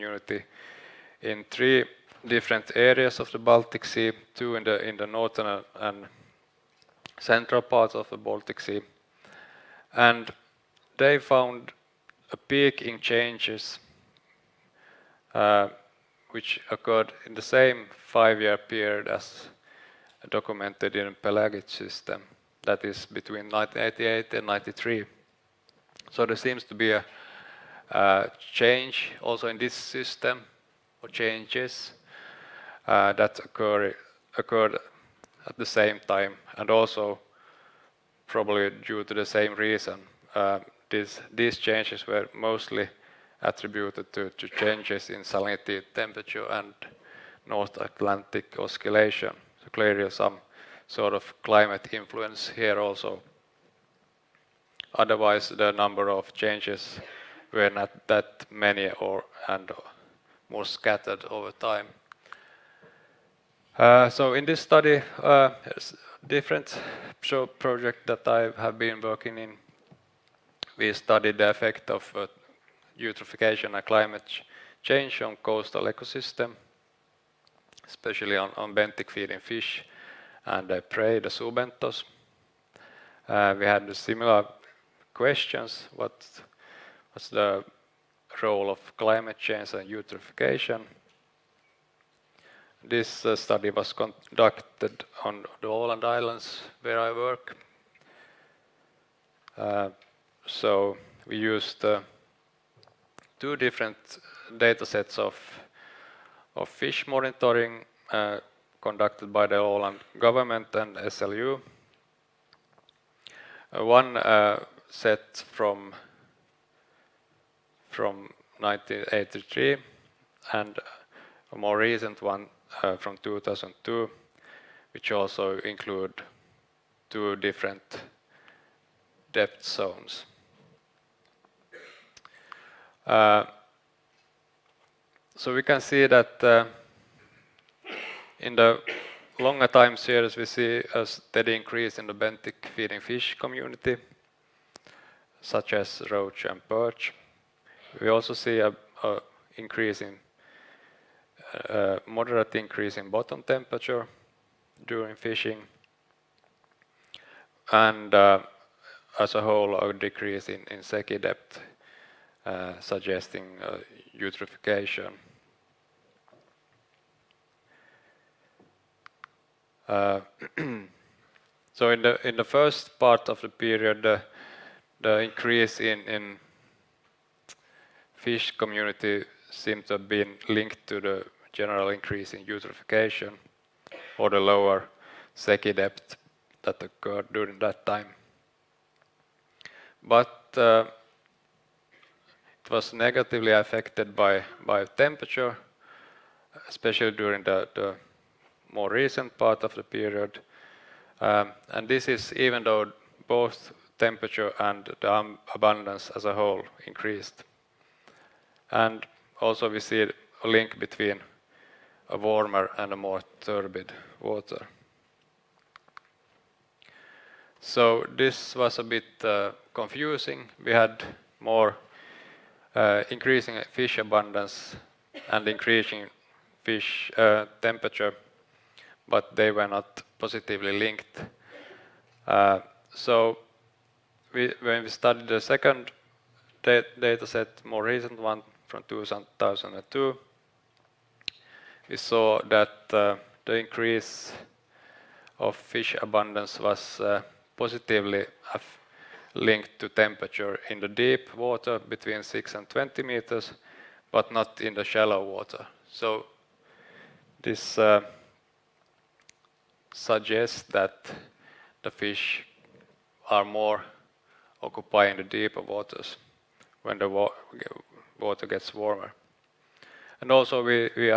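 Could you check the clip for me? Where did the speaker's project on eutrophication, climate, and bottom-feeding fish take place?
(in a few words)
Åland Islands.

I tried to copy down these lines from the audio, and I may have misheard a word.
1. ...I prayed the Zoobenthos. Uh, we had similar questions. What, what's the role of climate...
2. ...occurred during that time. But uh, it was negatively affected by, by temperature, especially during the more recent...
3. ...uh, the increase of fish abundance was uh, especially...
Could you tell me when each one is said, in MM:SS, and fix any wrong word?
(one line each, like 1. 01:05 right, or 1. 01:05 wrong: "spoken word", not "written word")
1. 01:20 right
2. 03:06 right
3. 04:02 wrong: "positively", not "especially".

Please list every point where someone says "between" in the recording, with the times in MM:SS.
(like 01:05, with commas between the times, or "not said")
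00:23, 03:30, 04:11.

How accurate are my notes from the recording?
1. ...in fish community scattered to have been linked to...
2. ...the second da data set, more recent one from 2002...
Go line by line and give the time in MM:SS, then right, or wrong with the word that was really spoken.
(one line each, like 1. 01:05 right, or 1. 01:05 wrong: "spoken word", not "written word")
1. 02:56 wrong: "seemed", not "scattered"
2. 03:55 right.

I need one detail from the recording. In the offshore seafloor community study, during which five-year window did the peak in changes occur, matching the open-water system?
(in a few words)
1988 to 1993.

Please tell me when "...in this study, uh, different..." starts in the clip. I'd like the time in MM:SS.
01:04.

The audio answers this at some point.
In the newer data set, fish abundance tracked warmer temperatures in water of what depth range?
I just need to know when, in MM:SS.
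04:11.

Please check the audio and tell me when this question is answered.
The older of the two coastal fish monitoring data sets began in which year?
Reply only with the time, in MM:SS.
01:58.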